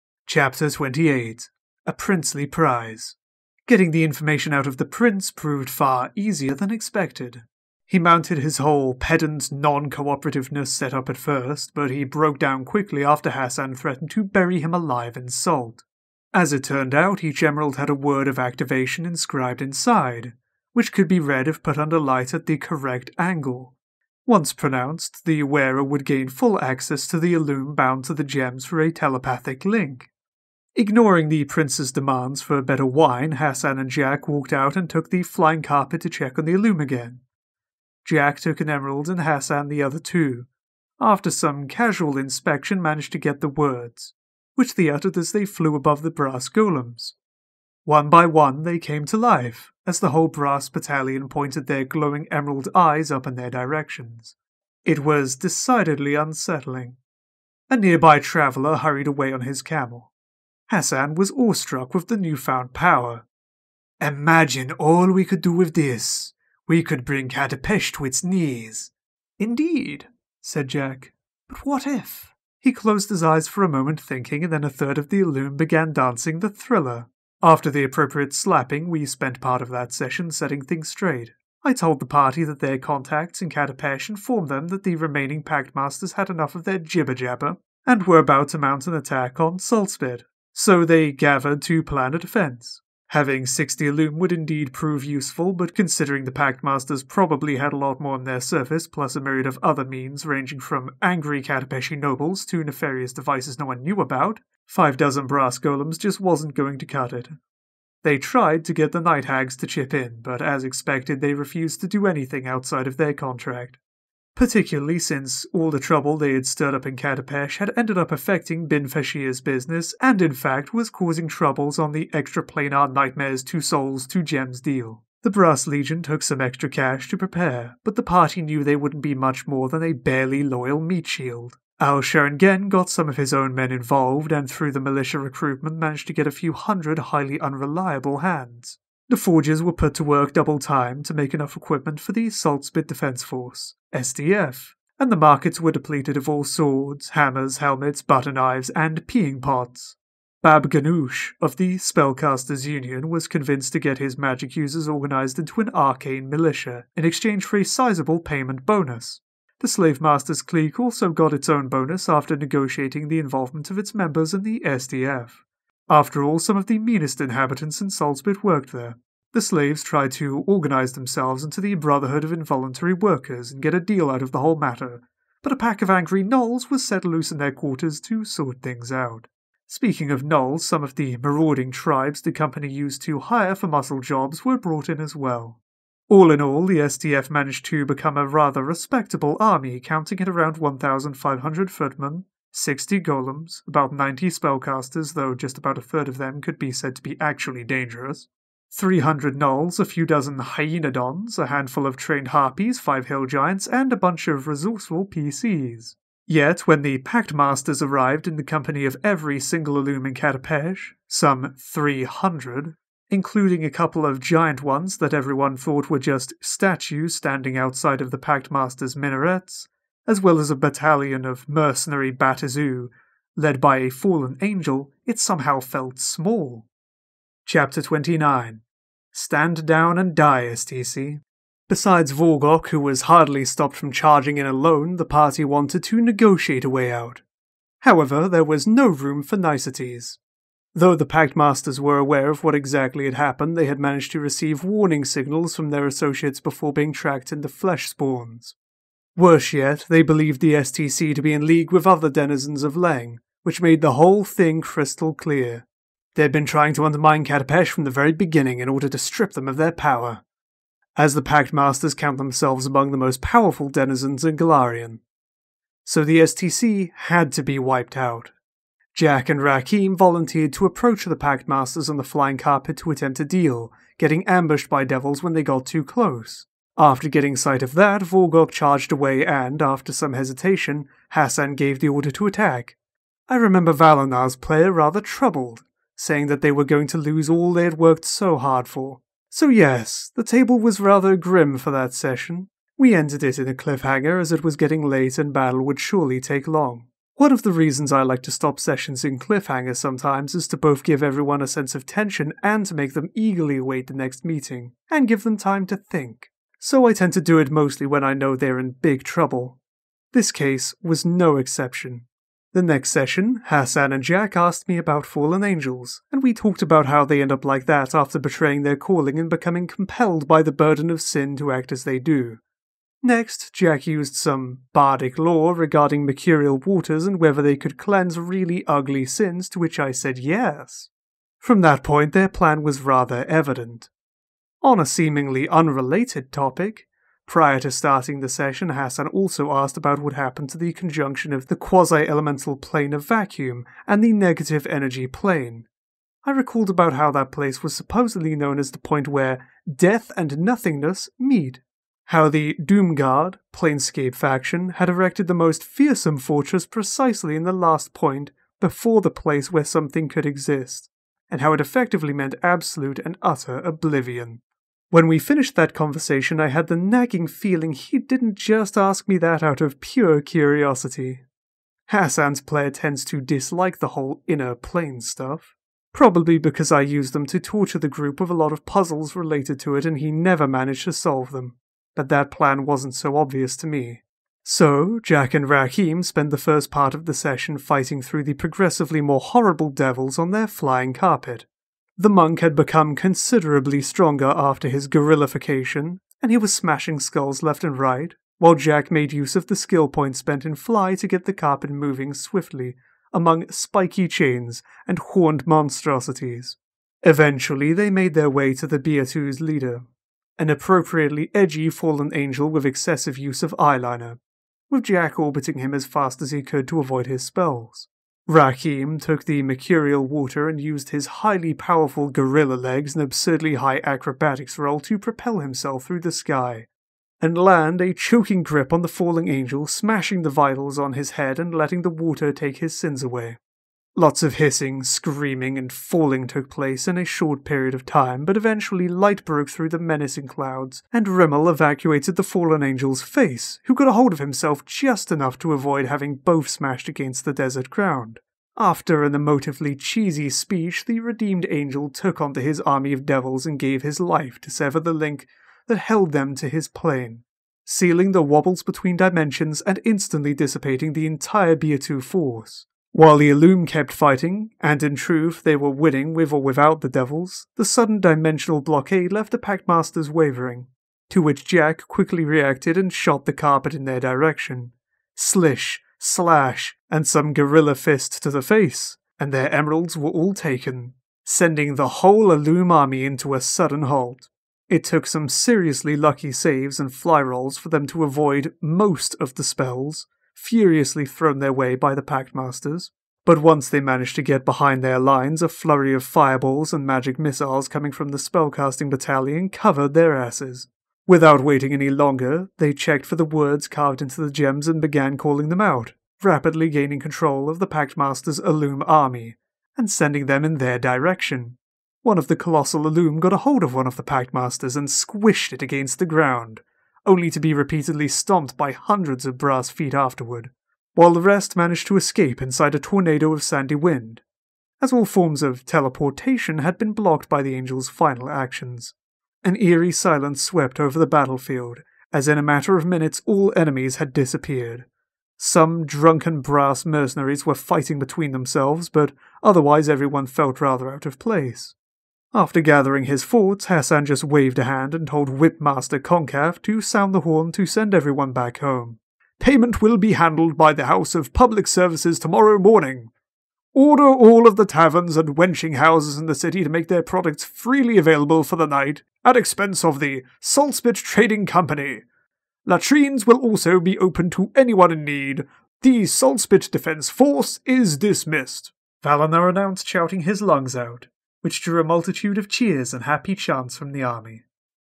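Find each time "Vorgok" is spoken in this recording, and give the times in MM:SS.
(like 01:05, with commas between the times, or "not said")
03:52, 04:38.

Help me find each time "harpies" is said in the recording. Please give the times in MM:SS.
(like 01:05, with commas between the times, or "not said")
03:22.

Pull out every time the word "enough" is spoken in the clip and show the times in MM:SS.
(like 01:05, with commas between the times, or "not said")
01:26, 02:21, 07:25.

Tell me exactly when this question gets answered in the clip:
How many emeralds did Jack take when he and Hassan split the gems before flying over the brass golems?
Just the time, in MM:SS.
00:38.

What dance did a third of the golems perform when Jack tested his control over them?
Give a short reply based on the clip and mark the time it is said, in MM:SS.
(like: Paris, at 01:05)
The thriller, at 01:16.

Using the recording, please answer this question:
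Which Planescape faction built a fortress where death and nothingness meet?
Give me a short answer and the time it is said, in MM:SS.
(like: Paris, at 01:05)
The Doomguard, at 05:52.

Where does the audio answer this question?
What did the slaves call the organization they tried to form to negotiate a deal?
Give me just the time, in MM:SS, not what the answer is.
02:51.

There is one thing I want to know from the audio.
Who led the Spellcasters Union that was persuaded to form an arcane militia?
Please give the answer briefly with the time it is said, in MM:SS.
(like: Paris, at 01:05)
Bab Ganoush, at 02:30.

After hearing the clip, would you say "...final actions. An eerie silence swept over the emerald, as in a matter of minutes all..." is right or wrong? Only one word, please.
wrong.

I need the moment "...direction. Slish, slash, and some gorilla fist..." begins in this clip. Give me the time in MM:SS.
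07:54.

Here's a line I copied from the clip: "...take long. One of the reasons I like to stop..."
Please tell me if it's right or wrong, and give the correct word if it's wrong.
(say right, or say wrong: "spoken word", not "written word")
right.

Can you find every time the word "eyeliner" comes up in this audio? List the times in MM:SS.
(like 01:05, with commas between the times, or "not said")
06:53.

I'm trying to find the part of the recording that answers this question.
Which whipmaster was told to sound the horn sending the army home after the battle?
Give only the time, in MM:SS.
09:05.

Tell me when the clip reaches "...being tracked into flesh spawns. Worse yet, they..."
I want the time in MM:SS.
04:06.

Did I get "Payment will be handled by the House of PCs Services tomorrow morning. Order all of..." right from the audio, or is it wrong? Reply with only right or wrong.
wrong.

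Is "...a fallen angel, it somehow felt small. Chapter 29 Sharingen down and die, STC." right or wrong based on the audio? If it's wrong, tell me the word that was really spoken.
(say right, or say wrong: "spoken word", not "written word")
wrong: "Stand", not "Sharingen".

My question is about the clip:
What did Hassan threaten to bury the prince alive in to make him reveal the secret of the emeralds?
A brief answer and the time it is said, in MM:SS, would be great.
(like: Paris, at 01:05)
Salt, at 00:15.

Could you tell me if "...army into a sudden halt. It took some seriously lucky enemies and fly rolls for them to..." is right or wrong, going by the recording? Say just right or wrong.
wrong.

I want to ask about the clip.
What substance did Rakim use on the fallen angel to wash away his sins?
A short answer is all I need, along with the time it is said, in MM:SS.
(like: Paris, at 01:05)
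Mercurial water, at 06:59.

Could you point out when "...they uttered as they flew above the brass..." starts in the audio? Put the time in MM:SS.
00:44.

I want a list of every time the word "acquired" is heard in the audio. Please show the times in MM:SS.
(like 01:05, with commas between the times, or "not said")
not said.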